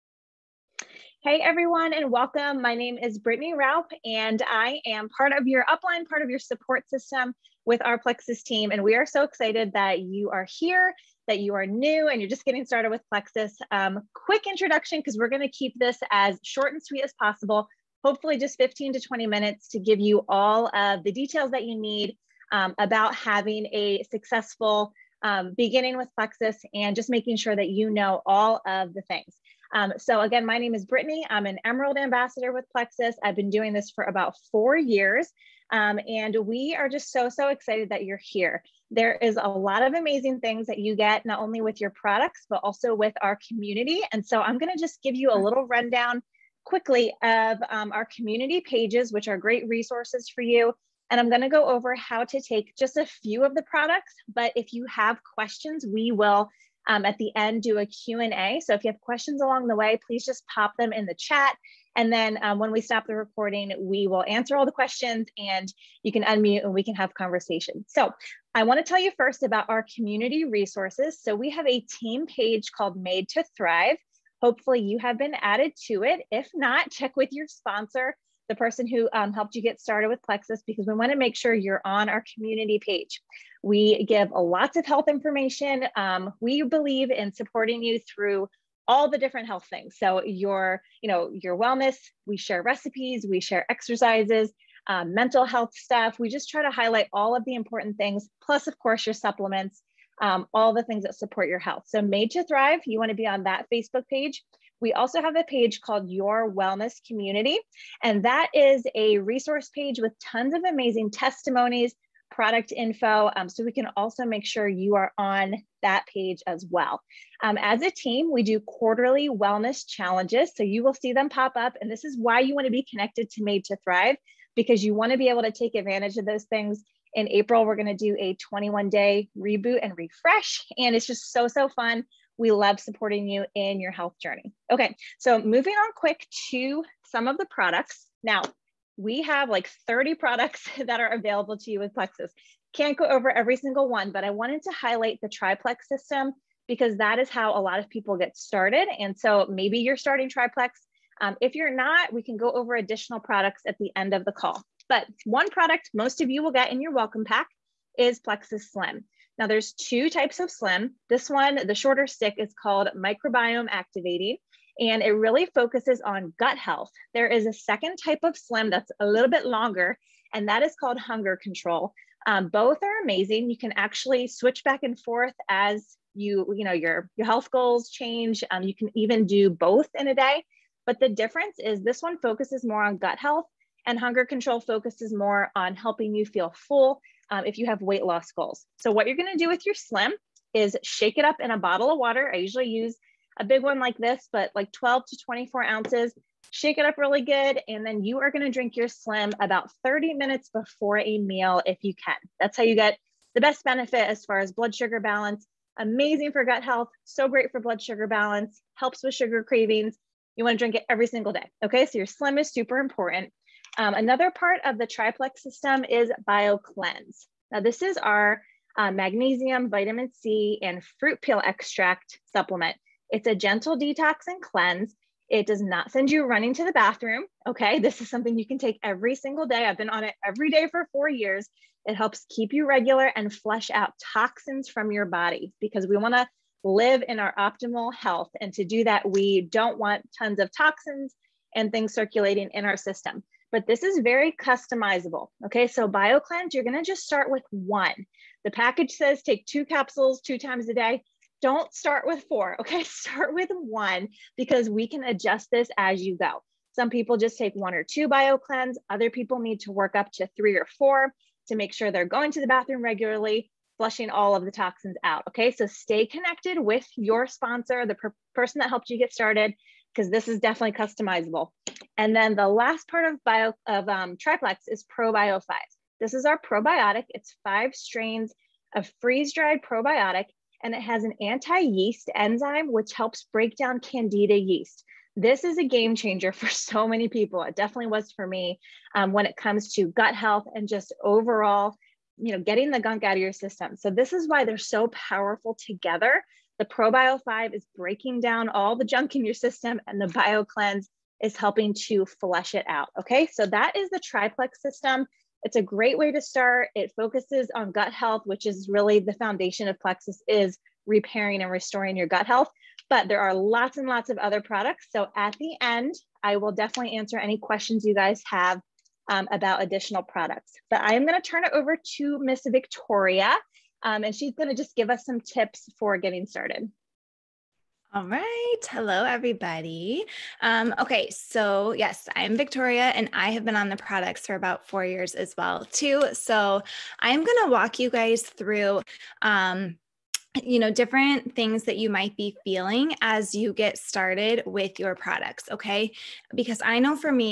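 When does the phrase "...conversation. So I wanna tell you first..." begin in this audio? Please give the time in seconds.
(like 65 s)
67 s.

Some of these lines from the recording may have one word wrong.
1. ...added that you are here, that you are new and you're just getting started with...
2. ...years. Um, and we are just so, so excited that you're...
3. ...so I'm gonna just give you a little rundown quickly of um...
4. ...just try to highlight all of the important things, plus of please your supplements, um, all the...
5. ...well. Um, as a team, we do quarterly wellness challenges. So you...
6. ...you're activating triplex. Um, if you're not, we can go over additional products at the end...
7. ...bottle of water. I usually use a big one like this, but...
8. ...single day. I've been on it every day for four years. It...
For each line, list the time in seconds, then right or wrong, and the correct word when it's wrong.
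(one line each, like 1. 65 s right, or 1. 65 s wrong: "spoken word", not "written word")
1. 9 s wrong: "excited", not "added"
2. 34 s right
3. 44 s right
4. 96 s wrong: "course", not "please"
5. 116 s right
6. 149 s wrong: "starting", not "activating"
7. 191 s right
8. 229 s right.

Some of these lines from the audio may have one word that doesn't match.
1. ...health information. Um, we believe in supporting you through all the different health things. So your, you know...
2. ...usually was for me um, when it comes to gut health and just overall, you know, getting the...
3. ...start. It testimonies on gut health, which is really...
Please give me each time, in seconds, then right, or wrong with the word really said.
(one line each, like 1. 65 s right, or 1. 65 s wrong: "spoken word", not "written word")
1. 84 s right
2. 287 s wrong: "definitely", not "usually"
3. 306 s wrong: "focuses", not "testimonies".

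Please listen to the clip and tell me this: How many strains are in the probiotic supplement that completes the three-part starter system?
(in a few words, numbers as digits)
5.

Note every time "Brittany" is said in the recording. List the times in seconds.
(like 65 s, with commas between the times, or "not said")
3 s, 30 s.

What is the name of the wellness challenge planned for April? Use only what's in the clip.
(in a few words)
21 day reboot and refresh.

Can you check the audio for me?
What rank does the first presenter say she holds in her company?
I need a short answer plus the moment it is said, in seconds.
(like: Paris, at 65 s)
Emerald Ambassador, at 31 s.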